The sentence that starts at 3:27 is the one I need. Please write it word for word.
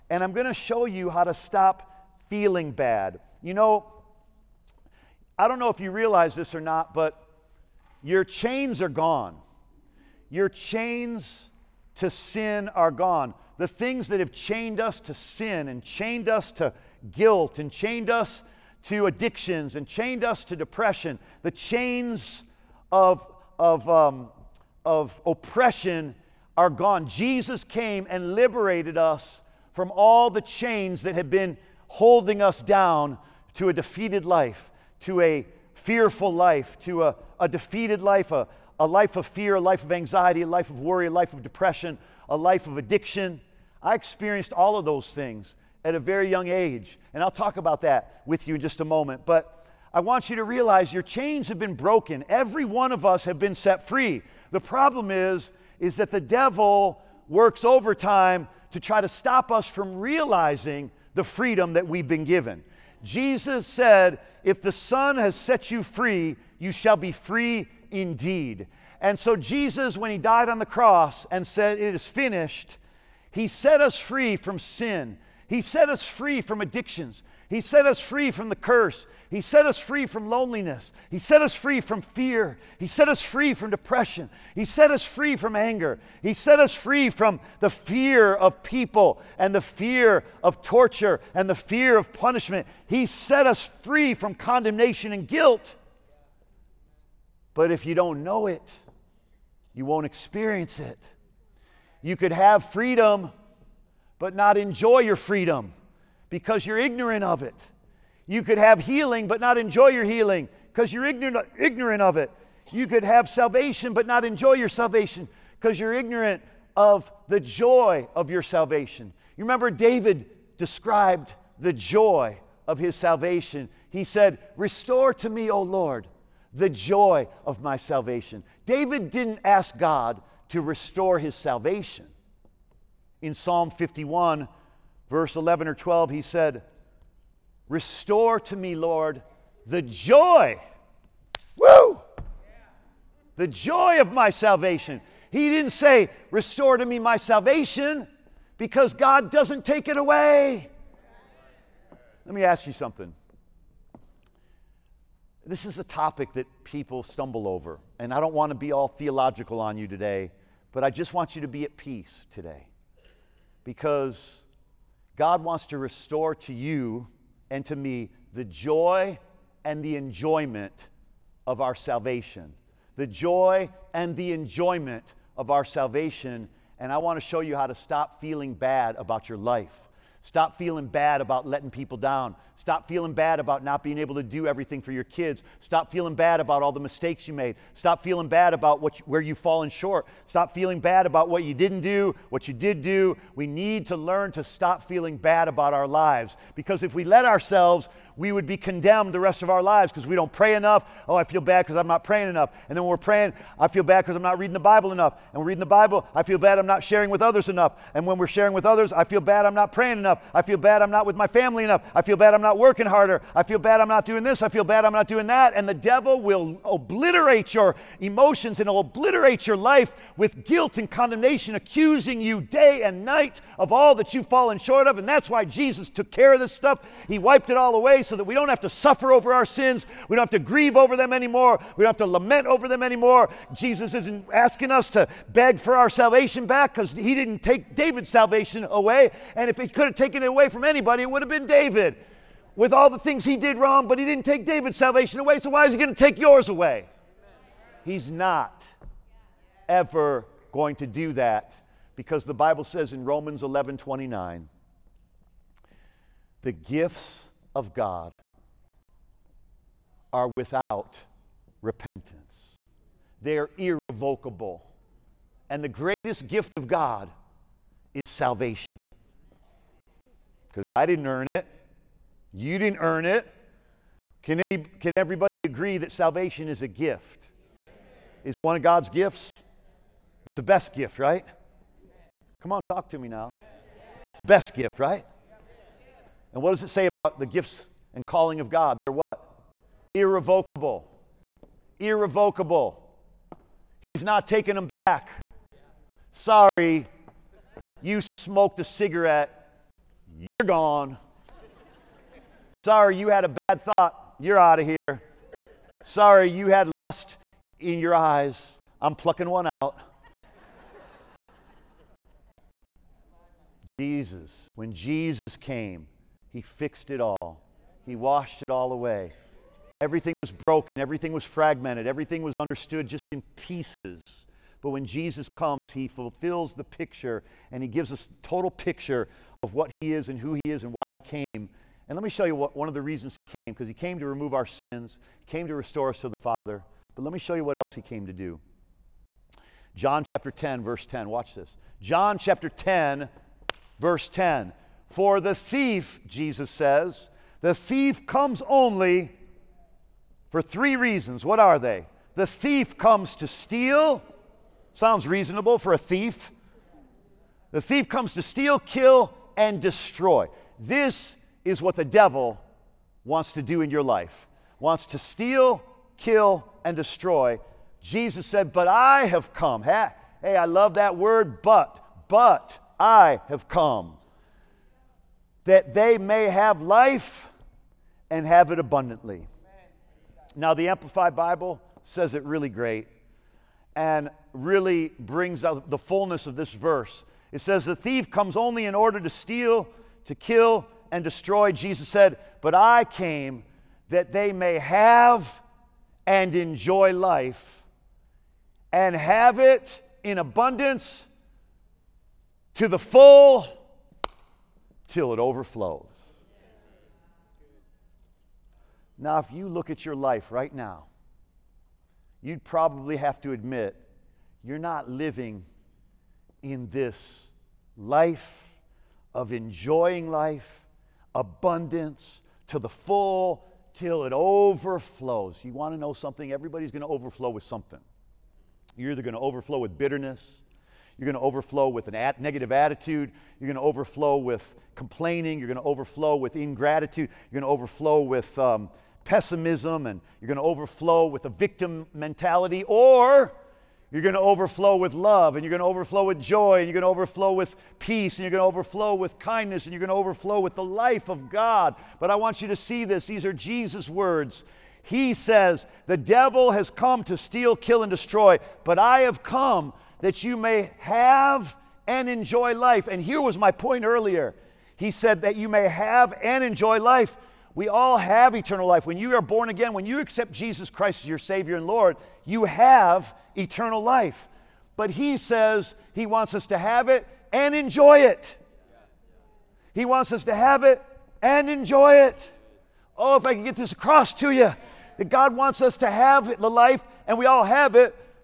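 And when we're sharing with others, I feel bad I'm not praying enough.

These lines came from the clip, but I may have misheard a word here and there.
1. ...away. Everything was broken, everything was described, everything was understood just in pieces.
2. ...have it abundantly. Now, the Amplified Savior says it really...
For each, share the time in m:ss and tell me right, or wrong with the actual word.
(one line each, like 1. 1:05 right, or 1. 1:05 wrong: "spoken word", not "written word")
1. 5:18 wrong: "fragmented", not "described"
2. 6:18 wrong: "Bible", not "Savior".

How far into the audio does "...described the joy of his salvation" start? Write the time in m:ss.
2:00.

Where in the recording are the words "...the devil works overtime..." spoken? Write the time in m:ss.
0:56.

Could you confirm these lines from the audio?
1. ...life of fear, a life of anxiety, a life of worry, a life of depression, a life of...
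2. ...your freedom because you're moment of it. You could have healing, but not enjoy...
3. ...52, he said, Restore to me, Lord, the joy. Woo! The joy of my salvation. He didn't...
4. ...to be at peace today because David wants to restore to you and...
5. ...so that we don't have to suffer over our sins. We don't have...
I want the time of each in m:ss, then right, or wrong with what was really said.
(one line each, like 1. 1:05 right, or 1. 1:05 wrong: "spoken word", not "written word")
1. 0:38 right
2. 1:44 wrong: "ignorant", not "moment"
3. 2:15 wrong: "12", not "52"
4. 2:41 wrong: "God", not "David"
5. 3:48 right.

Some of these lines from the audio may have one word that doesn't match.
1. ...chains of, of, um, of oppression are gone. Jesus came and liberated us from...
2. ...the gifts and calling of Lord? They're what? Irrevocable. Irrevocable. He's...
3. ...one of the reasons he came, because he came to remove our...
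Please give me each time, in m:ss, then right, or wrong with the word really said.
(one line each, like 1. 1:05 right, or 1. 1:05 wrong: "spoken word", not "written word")
1. 0:21 right
2. 4:47 wrong: "God", not "Lord"
3. 5:32 right.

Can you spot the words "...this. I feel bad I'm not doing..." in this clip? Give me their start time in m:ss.
3:34.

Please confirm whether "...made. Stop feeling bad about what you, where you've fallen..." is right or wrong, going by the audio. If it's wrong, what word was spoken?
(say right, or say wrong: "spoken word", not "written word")
right.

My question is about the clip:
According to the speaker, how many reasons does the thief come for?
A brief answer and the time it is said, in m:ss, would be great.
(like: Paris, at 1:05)
3, at 5:50.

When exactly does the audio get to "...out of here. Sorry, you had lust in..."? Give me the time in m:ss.
5:04.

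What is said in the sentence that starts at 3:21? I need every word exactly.
Oh, I feel bad because I'm not praying enough.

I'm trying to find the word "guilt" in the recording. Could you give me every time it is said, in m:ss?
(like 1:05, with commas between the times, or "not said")
0:17, 1:35, 3:40.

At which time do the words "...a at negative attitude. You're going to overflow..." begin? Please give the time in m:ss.
7:11.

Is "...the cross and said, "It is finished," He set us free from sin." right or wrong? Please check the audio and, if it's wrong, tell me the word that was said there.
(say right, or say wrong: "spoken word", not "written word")
right.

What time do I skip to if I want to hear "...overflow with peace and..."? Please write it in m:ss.
7:26.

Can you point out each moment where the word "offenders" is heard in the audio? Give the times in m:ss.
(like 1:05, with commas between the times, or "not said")
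not said.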